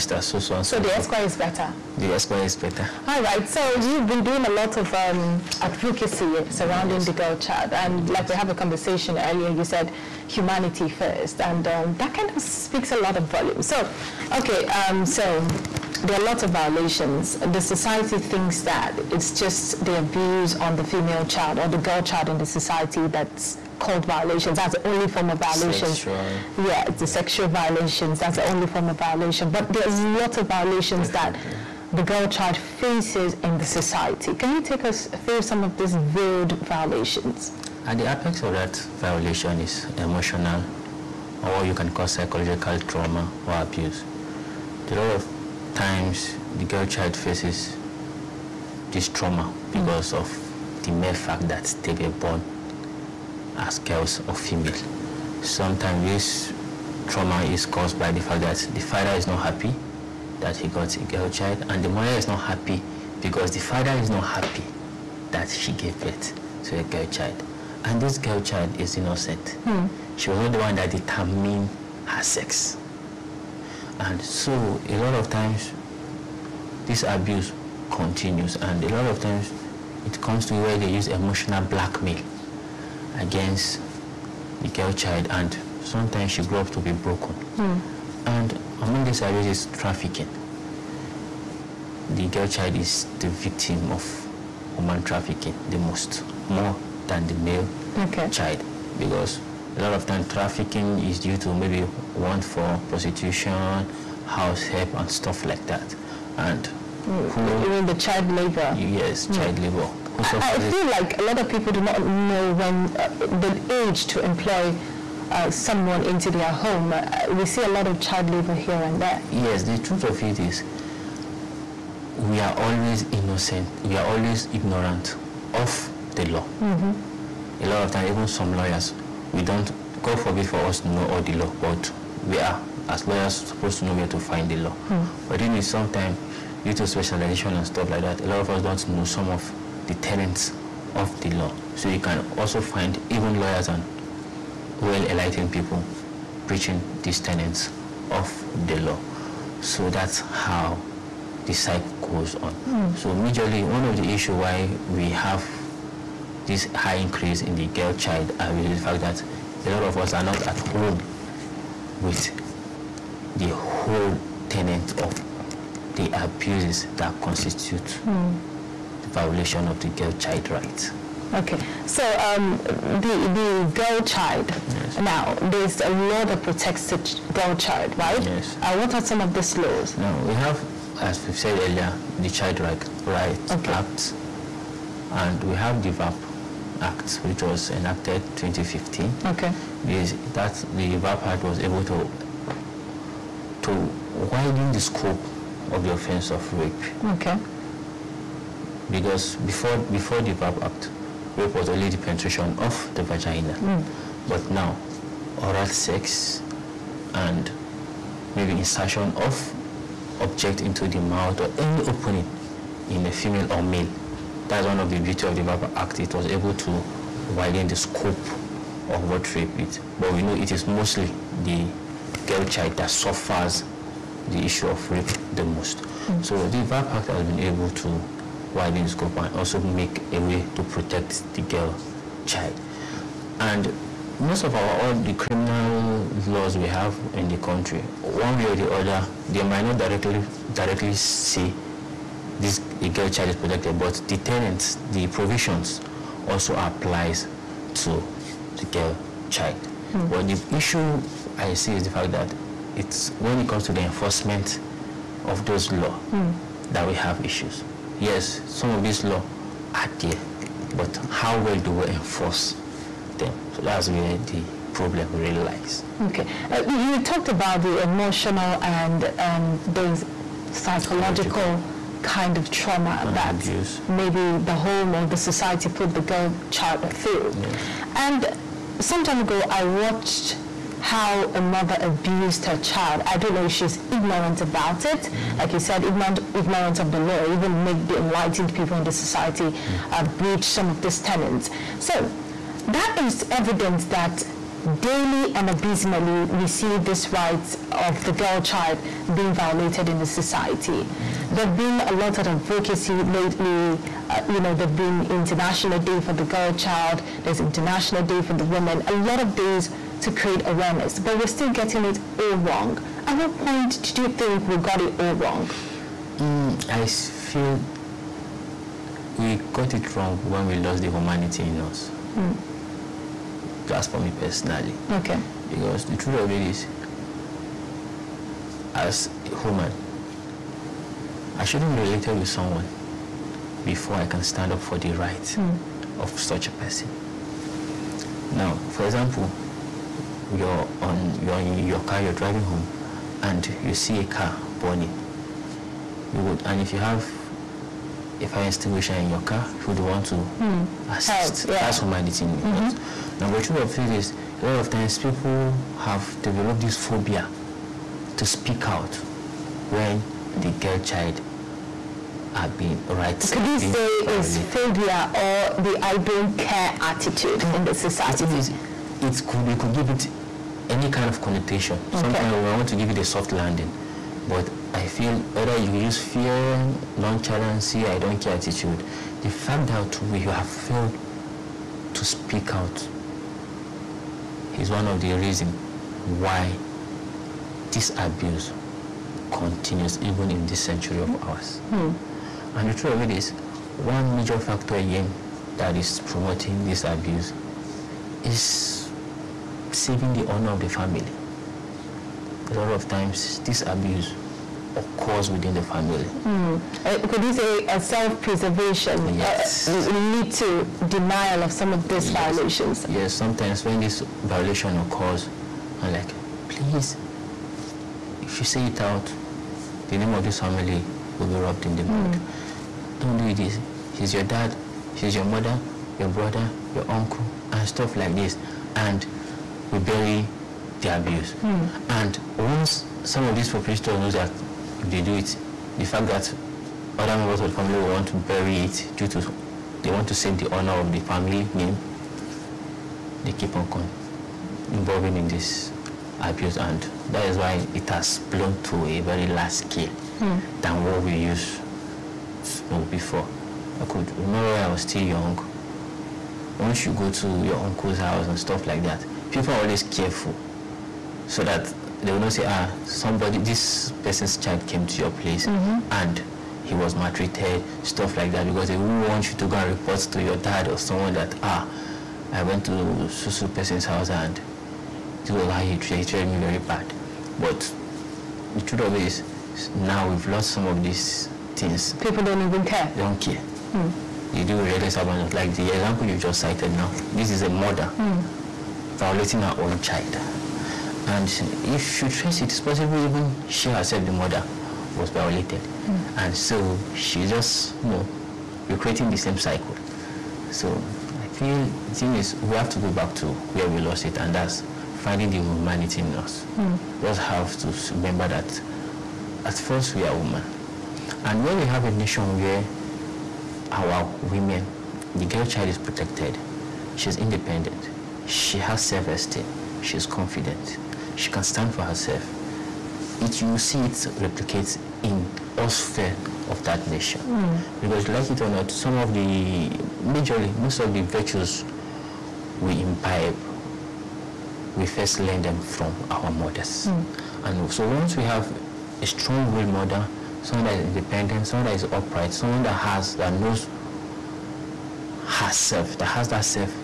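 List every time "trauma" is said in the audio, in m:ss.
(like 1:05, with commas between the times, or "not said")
0:42, 0:49, 0:57, 4:32.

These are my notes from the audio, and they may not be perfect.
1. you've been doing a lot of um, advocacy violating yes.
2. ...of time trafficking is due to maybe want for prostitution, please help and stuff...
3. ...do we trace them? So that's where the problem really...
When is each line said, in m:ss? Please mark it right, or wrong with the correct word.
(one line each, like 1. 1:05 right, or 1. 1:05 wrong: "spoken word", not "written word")
1. 0:03 wrong: "surrounding", not "violating"
2. 1:39 wrong: "house", not "please"
3. 4:21 wrong: "enforce", not "trace".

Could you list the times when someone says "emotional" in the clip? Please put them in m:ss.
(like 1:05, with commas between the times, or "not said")
0:39, 1:21, 4:27.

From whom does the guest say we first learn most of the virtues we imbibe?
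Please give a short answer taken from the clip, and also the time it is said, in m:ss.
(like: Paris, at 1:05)
Our mothers, at 8:56.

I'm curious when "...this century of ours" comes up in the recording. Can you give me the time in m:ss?
6:30.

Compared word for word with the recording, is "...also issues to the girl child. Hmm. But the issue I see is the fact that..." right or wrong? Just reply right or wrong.
wrong.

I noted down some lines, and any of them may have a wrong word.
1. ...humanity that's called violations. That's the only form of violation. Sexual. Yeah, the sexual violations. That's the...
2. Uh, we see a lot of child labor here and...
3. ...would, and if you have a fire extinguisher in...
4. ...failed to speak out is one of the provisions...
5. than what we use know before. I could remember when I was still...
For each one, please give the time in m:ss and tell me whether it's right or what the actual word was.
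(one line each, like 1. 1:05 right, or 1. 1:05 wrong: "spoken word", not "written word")
1. 0:22 wrong: "society", not "humanity"
2. 1:56 right
3. 5:46 right
4. 6:20 wrong: "reasons", not "provisions"
5. 7:30 right.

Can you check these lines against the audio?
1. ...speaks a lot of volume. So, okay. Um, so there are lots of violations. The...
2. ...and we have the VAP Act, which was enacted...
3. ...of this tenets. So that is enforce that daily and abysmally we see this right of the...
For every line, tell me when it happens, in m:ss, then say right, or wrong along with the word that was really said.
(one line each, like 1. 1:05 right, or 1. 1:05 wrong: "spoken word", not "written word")
1. 0:12 right
2. 3:05 right
3. 4:50 wrong: "evidence", not "enforce".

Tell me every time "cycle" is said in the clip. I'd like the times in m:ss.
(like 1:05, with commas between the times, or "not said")
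2:31, 8:19.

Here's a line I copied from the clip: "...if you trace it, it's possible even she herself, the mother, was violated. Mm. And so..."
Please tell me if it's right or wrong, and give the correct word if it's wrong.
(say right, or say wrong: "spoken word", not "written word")
right.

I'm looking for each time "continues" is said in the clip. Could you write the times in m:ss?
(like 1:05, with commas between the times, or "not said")
1:17, 6:29.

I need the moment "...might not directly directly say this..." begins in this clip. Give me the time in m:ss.
3:59.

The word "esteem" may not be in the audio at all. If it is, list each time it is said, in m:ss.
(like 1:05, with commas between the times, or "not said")
8:38.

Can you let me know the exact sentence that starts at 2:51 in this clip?
Okay, so um, the the girl child.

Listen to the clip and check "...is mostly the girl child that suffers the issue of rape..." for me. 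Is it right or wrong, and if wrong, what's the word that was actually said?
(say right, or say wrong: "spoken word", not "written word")
right.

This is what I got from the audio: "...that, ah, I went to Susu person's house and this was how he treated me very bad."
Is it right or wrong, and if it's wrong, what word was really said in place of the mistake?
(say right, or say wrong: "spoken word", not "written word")
right.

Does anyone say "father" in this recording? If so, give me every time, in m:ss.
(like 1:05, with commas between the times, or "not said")
0:58, 1:03.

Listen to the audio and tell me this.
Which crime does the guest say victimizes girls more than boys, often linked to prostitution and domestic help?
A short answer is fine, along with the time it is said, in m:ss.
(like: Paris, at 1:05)
Human trafficking, at 1:34.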